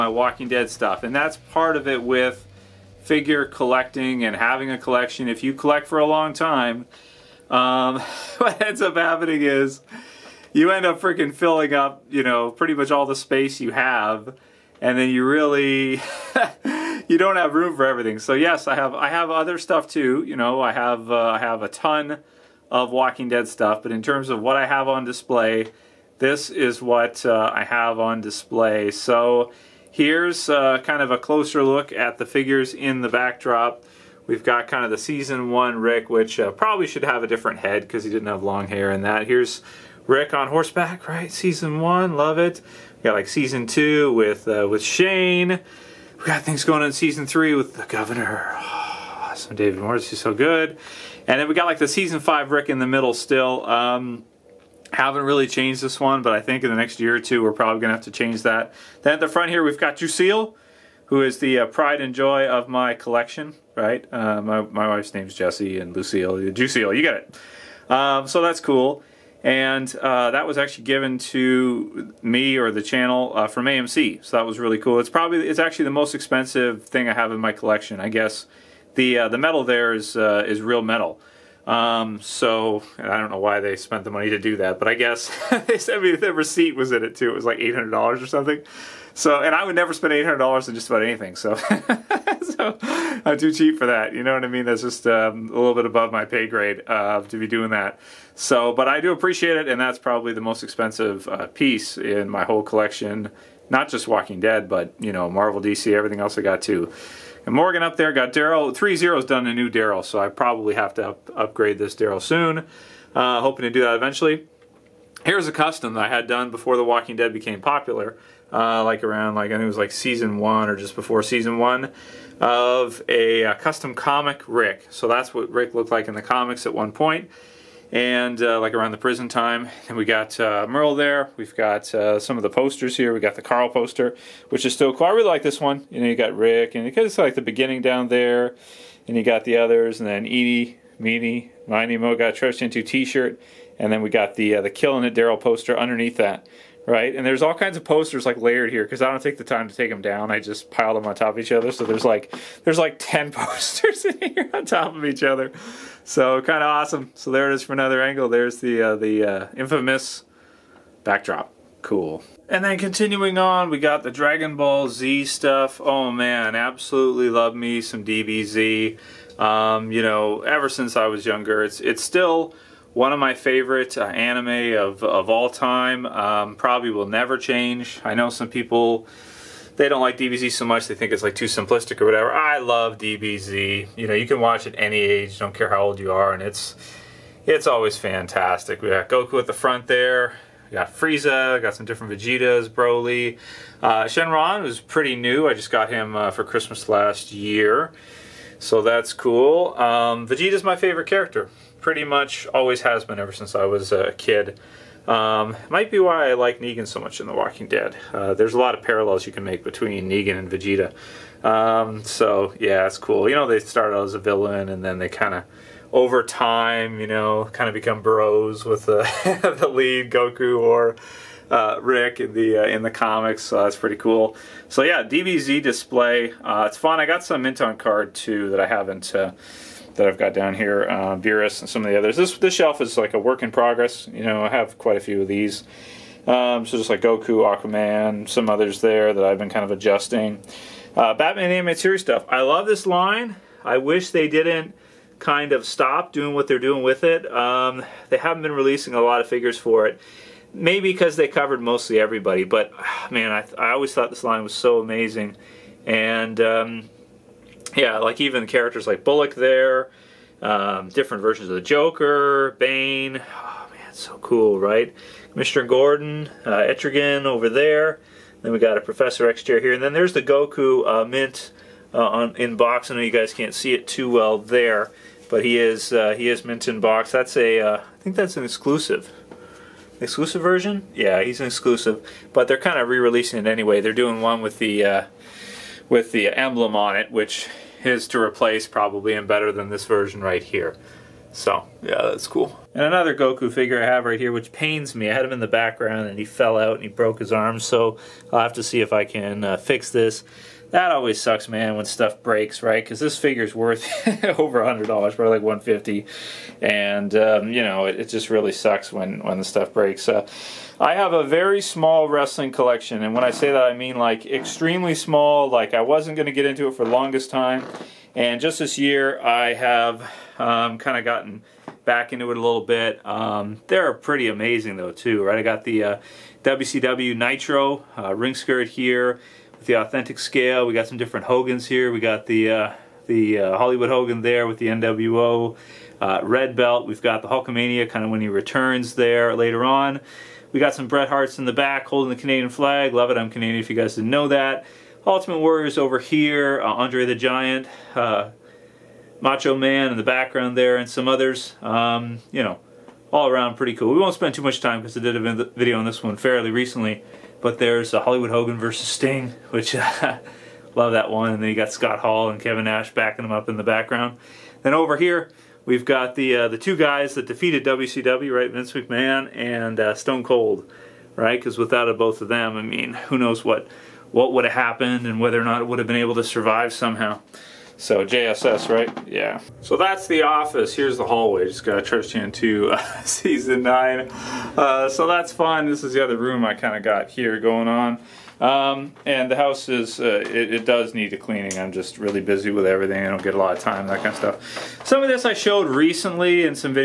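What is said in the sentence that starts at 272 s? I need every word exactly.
I know you guys can't see it too well there, but he is uh, he is mint in box.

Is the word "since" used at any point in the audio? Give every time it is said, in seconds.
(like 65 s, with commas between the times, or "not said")
170 s, 203 s.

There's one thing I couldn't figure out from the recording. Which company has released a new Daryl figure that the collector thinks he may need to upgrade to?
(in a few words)
Threezero.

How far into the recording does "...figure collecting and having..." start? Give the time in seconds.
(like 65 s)
3 s.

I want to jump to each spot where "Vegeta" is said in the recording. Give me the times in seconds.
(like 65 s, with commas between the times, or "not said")
192 s, 200 s, 210 s.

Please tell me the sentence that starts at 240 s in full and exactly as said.
Uh, Batman and Animated Series stuff.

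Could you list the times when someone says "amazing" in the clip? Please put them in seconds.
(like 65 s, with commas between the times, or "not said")
254 s, 324 s.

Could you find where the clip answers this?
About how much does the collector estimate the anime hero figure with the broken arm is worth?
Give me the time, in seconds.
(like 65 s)
305 s.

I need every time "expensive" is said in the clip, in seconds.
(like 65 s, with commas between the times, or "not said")
76 s, 100 s.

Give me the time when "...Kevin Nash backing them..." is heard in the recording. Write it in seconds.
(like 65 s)
362 s.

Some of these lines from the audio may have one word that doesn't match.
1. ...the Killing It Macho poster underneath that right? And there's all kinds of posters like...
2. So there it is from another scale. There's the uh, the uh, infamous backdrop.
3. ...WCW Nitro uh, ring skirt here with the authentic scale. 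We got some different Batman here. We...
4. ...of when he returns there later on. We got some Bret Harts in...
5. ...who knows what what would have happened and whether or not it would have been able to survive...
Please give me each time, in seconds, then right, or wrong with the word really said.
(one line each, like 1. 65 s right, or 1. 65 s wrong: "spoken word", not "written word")
1. 144 s wrong: "Daryl", not "Macho"
2. 157 s wrong: "angle", not "scale"
3. 326 s wrong: "Hogans", not "Batman"
4. 338 s right
5. 372 s right.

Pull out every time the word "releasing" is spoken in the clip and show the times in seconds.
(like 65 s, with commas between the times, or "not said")
248 s, 282 s.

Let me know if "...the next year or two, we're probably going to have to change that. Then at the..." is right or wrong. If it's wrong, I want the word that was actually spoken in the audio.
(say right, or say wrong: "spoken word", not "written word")
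right.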